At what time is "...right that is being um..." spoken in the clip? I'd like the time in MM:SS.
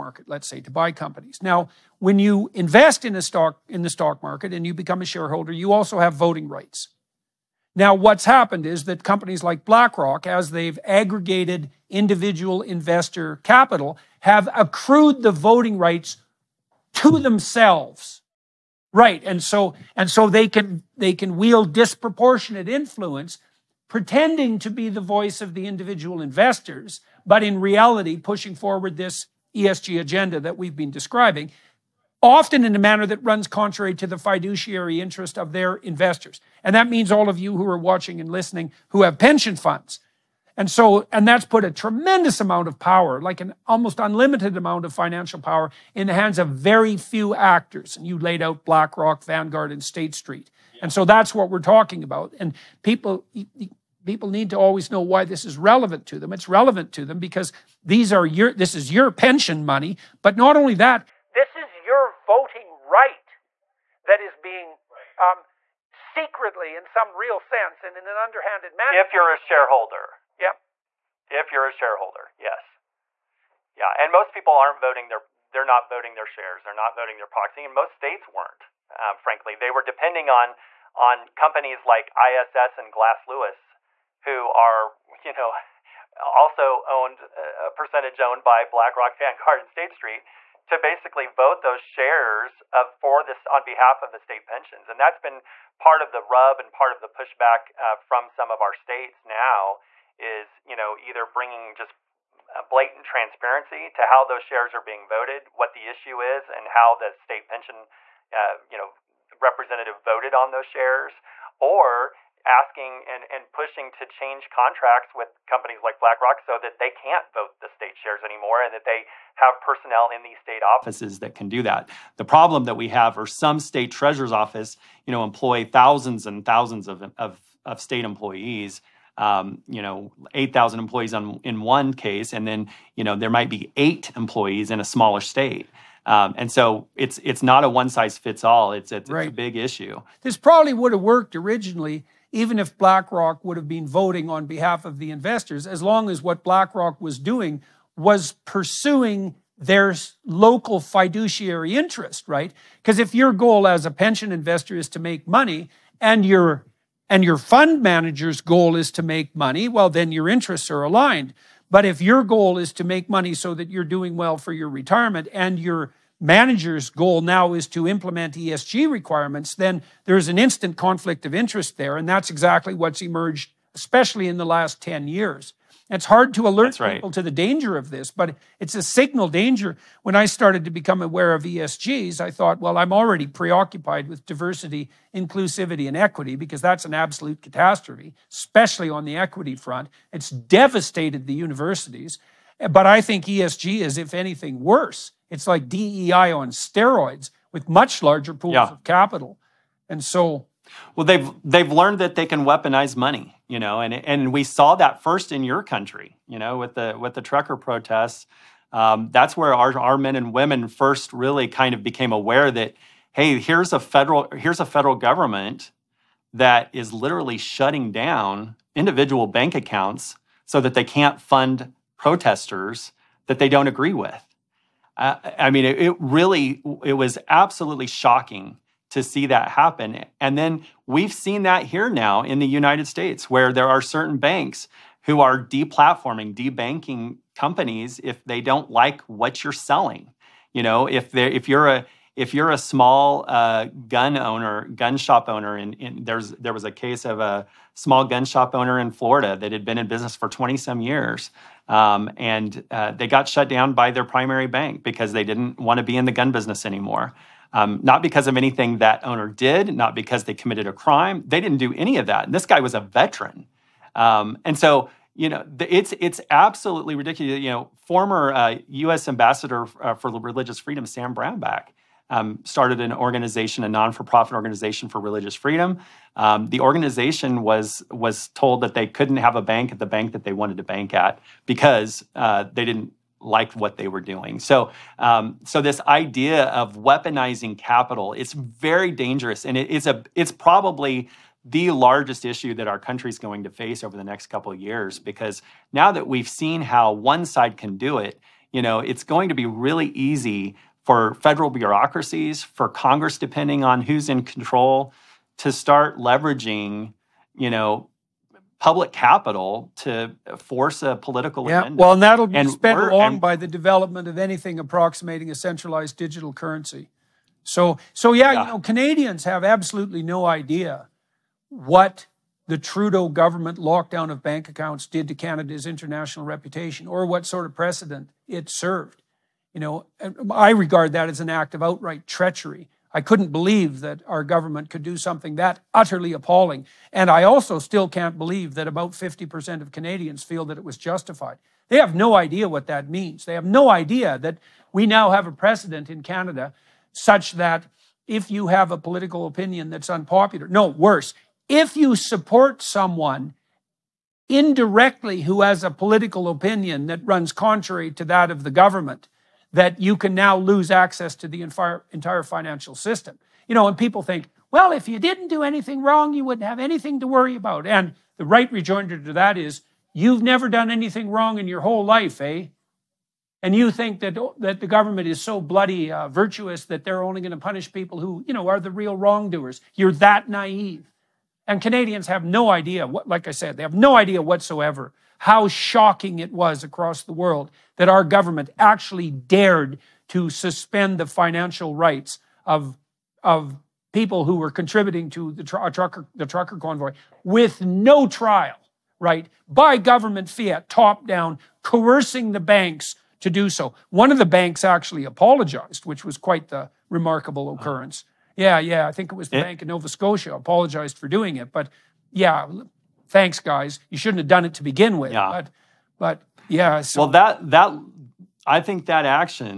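01:02.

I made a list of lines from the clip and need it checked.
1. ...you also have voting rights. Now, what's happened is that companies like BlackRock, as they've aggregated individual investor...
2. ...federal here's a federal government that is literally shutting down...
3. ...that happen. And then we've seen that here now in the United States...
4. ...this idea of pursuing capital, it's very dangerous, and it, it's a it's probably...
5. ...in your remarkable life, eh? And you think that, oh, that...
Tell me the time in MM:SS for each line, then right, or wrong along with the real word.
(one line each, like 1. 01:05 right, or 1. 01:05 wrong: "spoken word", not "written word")
1. 00:05 right
2. 03:33 right
3. 03:49 right
4. 04:45 wrong: "weaponizing", not "pursuing"
5. 06:11 wrong: "whole", not "remarkable".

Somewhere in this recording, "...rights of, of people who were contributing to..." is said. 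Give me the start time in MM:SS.
06:31.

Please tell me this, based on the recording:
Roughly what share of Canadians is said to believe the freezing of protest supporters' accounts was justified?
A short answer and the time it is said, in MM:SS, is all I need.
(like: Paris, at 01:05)
50%, at 05:38.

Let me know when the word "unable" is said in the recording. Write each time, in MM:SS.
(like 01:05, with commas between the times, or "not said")
not said.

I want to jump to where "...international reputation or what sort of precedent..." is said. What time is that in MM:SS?
05:25.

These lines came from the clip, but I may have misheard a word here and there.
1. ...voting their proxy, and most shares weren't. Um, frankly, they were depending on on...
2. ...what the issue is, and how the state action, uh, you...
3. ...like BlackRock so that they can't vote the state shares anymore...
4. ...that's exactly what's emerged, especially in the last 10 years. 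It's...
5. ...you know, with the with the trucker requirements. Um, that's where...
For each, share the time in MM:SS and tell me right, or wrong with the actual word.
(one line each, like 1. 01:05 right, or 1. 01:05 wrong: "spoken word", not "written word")
1. 01:16 wrong: "states", not "shares"
2. 01:45 wrong: "pension", not "action"
3. 01:55 right
4. 02:52 right
5. 03:26 wrong: "protests", not "requirements".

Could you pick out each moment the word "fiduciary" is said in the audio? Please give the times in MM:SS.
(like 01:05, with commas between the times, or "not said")
00:34, 02:30.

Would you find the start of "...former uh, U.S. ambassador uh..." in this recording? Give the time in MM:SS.
04:27.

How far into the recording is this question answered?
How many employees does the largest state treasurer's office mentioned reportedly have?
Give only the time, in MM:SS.
02:10.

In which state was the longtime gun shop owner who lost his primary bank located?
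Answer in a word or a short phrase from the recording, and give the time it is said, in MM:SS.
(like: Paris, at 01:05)
Florida, at 04:08.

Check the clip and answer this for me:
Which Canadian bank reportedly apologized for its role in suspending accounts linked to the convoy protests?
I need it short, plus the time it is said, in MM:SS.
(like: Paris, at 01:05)
Bank of Nova Scotia, at 06:49.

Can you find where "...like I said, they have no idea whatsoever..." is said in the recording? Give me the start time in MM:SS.
06:23.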